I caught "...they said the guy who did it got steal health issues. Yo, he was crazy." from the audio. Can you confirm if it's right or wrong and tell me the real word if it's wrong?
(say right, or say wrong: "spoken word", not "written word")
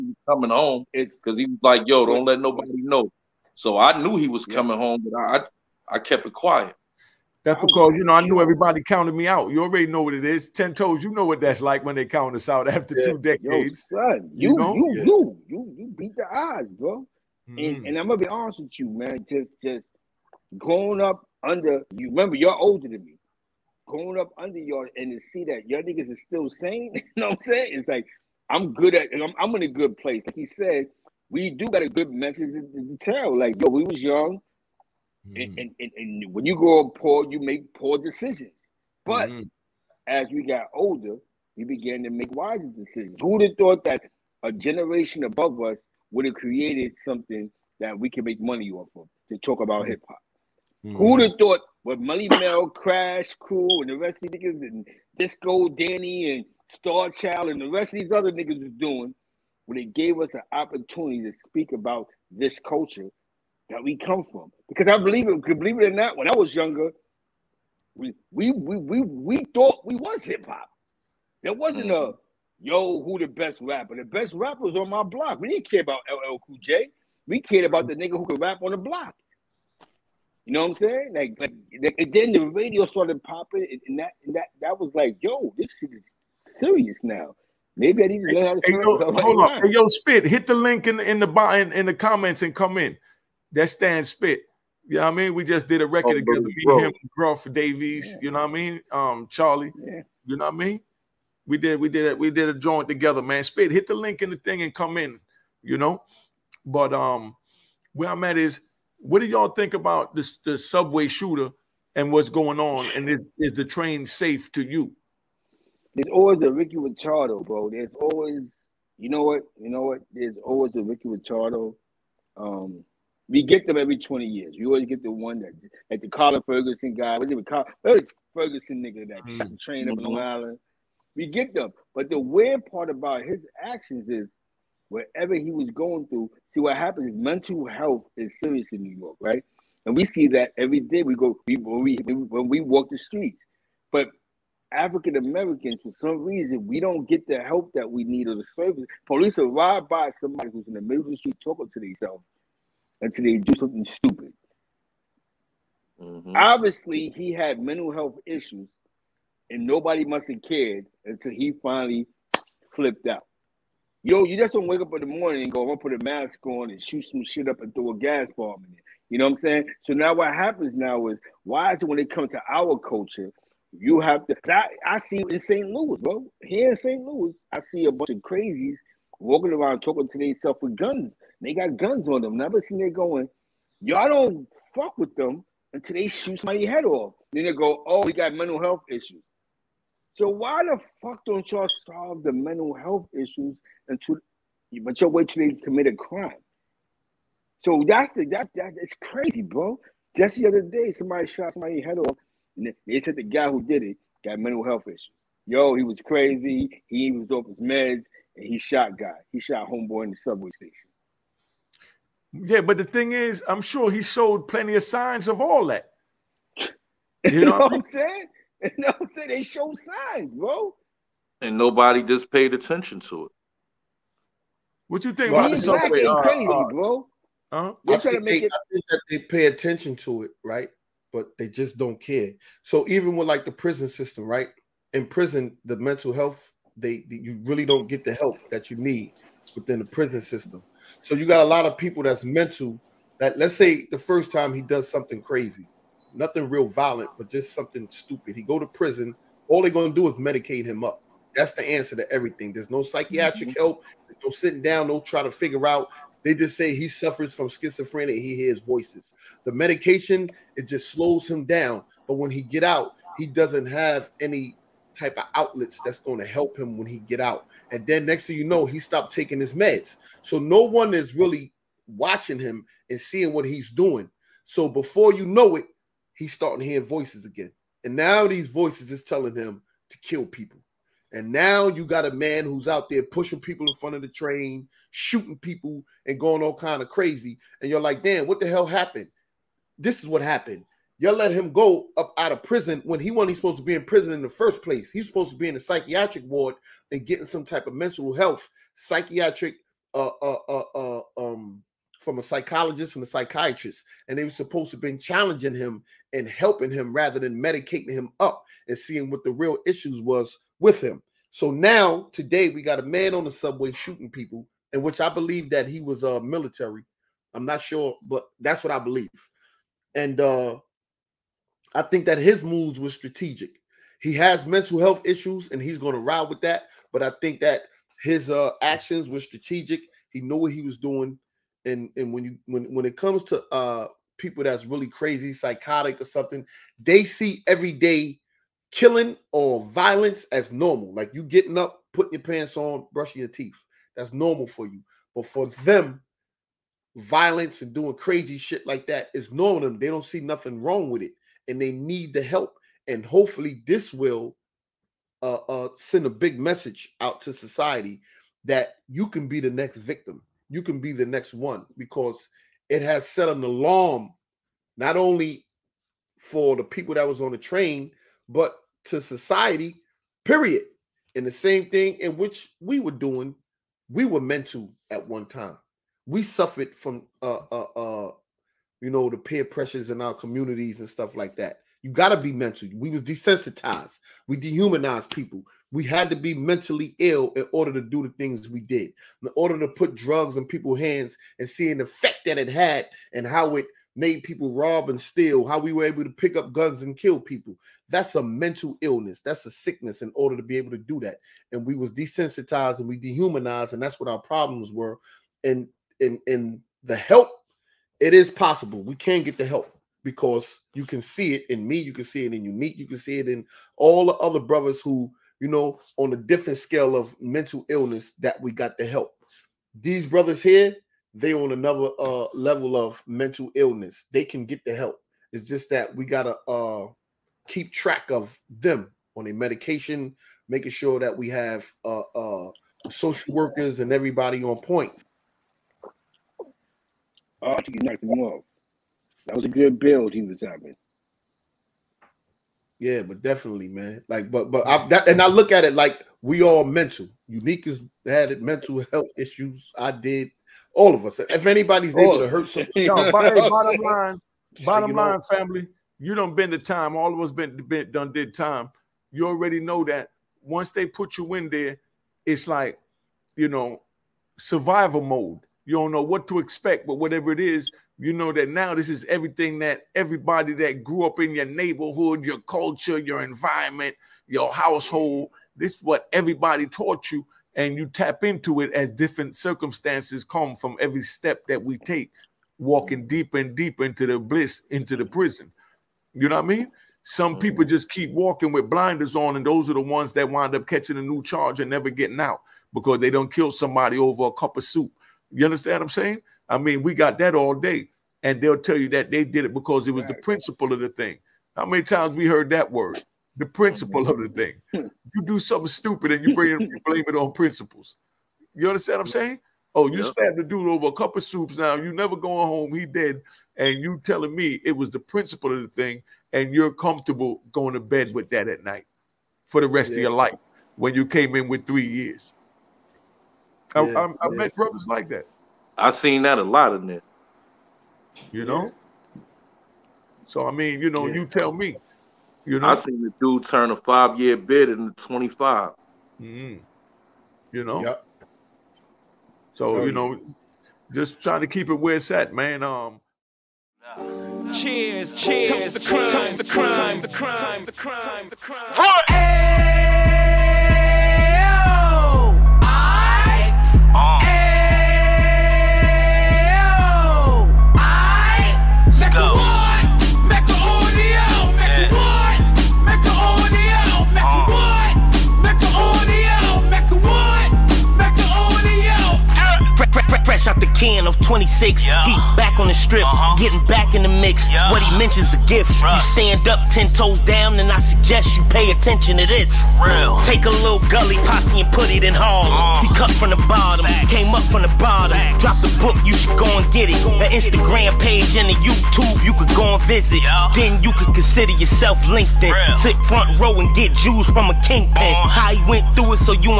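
wrong: "mental", not "steal".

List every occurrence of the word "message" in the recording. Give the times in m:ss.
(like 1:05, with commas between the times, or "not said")
0:32, 5:56.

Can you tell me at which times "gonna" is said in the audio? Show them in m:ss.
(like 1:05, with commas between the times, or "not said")
0:18, 2:45, 4:09.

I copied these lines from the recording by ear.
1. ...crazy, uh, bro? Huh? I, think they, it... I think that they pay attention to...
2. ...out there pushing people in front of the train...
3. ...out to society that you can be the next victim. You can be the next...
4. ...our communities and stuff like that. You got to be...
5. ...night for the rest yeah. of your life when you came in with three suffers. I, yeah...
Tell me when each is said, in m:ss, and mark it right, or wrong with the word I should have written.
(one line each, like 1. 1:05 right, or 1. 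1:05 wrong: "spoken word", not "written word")
1. 3:46 right
2. 4:42 right
3. 5:57 right
4. 6:20 right
5. 8:38 wrong: "years", not "suffers".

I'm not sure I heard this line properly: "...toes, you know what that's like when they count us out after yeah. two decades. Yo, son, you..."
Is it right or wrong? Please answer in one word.
right.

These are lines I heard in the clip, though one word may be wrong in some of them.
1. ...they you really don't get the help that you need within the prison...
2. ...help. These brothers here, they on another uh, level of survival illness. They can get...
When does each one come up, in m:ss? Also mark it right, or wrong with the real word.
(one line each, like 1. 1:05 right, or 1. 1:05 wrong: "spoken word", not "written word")
1. 3:56 right
2. 6:58 wrong: "mental", not "survival".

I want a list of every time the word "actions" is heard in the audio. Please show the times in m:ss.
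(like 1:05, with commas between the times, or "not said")
2:13, 5:28.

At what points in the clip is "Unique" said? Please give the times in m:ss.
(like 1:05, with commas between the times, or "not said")
6:52, 7:27.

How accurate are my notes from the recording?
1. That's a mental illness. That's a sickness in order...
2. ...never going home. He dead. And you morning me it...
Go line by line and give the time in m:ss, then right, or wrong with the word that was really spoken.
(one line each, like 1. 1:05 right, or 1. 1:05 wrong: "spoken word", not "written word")
1. 6:37 right
2. 8:31 wrong: "telling", not "morning".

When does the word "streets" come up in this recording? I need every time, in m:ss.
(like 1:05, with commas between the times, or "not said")
2:22, 2:31.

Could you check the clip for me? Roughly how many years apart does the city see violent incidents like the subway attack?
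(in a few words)
20.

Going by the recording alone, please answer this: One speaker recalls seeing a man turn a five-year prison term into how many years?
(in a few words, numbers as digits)
25.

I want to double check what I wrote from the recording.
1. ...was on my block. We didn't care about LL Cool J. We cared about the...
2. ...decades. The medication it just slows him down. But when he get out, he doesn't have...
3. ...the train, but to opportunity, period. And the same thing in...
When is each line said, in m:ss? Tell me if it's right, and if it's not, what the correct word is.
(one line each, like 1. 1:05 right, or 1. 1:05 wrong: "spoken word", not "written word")
1. 1:14 right
2. 4:18 wrong: "voices", not "decades"
3. 6:07 wrong: "society", not "opportunity".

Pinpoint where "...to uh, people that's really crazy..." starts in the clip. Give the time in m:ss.
5:33.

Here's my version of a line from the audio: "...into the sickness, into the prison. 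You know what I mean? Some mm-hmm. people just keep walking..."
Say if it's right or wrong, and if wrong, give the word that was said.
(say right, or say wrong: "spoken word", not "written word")
wrong: "bliss", not "sickness".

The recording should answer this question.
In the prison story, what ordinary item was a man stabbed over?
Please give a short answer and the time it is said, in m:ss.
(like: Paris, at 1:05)
A cup of soup, at 8:14.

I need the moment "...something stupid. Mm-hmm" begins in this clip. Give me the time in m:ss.
2:33.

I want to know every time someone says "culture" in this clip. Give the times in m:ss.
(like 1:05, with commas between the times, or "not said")
1:02, 2:52, 7:52.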